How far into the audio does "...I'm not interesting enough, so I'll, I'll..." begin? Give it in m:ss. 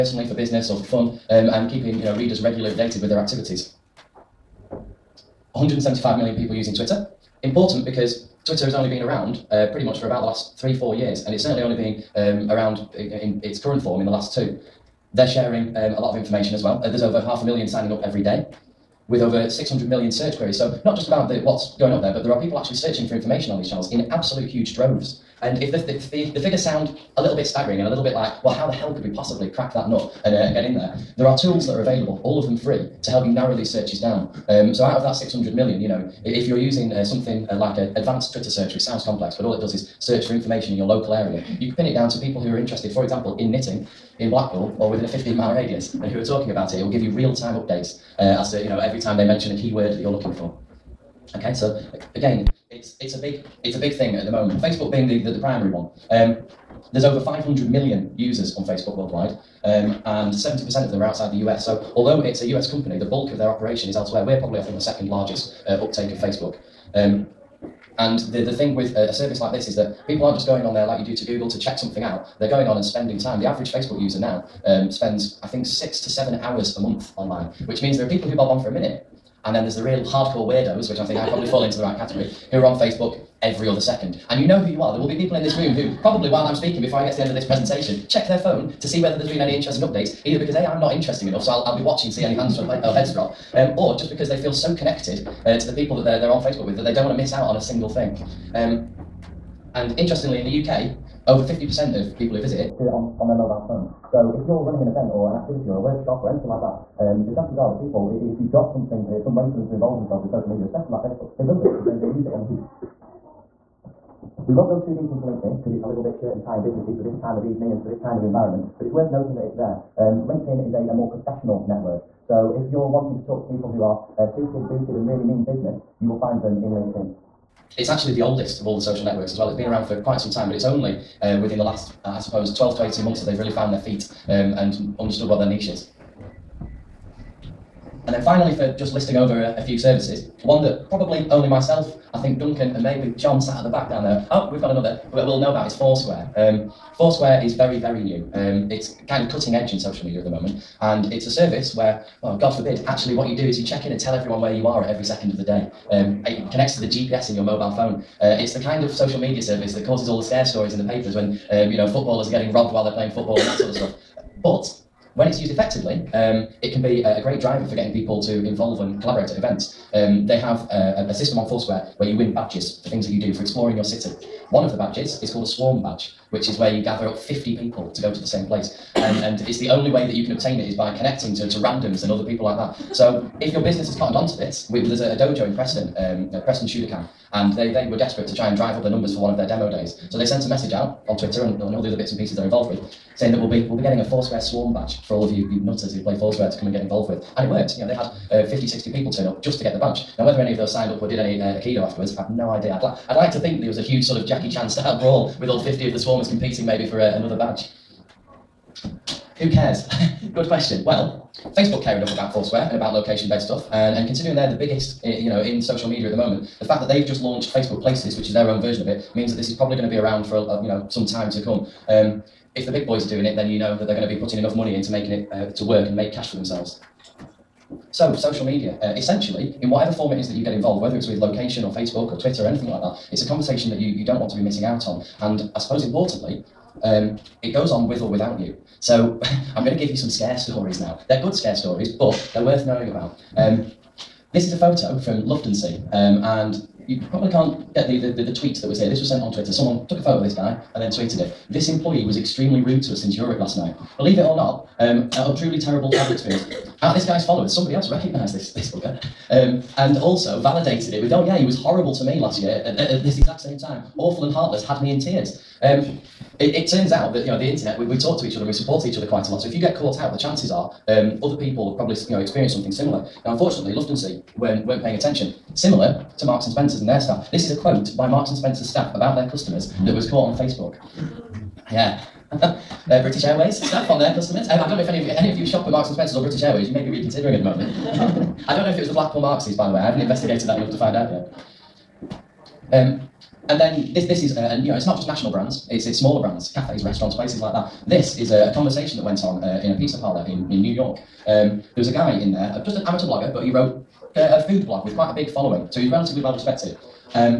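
1:30.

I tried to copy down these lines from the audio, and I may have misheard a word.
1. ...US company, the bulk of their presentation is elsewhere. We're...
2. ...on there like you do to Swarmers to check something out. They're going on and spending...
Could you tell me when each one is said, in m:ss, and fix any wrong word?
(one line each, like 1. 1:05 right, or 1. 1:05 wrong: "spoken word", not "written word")
1. 1:02 wrong: "operation", not "presentation"
2. 1:10 wrong: "Google", not "Swarmers".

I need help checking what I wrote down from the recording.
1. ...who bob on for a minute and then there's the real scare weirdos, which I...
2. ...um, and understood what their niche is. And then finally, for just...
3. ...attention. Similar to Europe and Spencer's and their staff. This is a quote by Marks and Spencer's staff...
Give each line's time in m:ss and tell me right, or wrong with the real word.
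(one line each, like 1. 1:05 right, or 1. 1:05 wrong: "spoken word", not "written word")
1. 1:18 wrong: "hardcore", not "scare"
2. 2:14 right
3. 4:34 wrong: "Marks", not "Europe".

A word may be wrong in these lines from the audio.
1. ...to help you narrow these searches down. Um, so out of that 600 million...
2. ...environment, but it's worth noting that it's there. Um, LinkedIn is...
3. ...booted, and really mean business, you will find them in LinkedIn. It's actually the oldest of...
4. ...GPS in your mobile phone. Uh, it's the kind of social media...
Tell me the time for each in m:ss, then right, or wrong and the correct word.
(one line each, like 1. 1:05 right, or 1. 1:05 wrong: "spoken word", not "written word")
1. 0:33 right
2. 1:58 right
3. 2:04 right
4. 2:36 right.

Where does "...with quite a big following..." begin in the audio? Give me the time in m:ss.
5:04.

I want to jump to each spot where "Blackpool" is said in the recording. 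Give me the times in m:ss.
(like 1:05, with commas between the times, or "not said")
0:44, 4:48.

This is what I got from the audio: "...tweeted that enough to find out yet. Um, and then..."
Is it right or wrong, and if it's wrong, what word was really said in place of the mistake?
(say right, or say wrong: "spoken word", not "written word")
wrong: "investigated", not "tweeted".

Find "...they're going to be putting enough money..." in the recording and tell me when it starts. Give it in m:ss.
3:43.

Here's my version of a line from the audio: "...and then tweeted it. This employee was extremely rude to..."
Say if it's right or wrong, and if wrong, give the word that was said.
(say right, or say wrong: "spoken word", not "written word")
right.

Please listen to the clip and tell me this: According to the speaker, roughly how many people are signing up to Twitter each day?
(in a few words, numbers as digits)
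over half a million.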